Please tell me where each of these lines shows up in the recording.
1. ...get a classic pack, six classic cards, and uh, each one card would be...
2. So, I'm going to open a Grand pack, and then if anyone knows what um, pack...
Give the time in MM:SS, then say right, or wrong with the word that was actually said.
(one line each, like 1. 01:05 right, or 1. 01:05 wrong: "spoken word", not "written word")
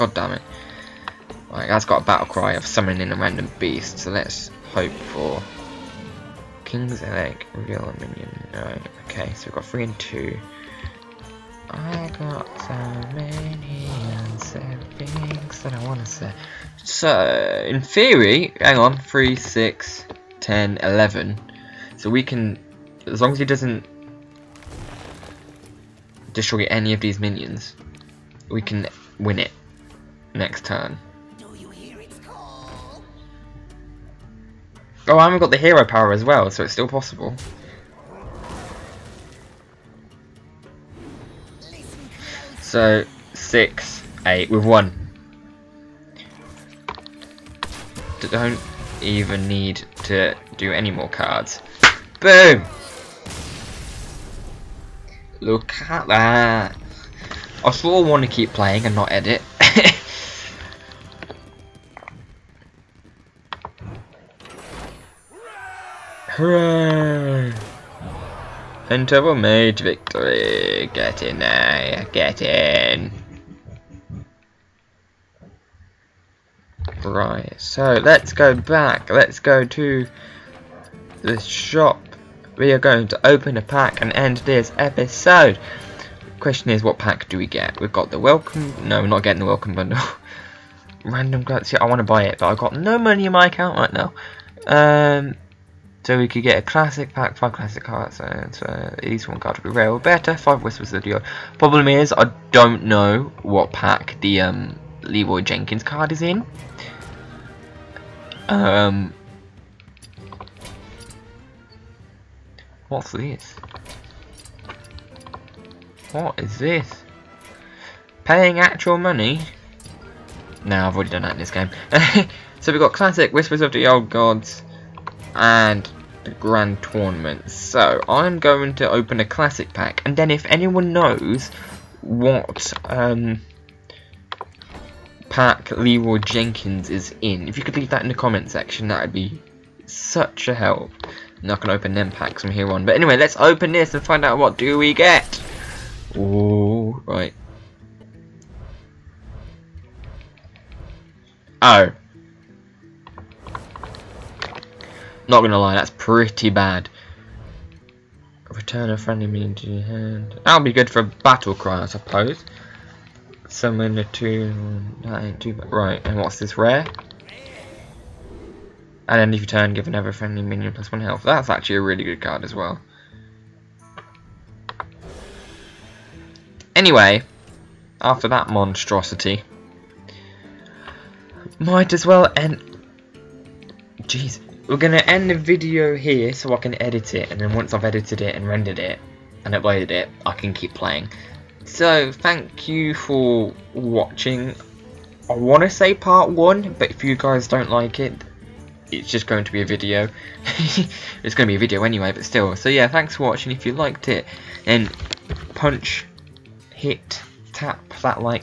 1. 01:36 wrong: "five", not "six"
2. 02:07 wrong: "Classic", not "Grand".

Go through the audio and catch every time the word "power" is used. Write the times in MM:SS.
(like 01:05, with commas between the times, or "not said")
00:35.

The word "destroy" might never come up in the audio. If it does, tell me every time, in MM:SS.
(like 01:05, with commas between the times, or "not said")
00:26.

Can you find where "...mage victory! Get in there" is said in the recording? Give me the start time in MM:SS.
01:09.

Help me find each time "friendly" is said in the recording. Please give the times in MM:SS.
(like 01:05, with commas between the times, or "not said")
02:38, 02:50.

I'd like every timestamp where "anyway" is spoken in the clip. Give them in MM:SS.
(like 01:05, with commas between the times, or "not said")
02:22, 02:56, 03:21.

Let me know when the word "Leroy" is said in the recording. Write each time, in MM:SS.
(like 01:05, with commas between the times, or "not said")
01:45, 02:15.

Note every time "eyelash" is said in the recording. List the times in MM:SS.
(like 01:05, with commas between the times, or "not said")
not said.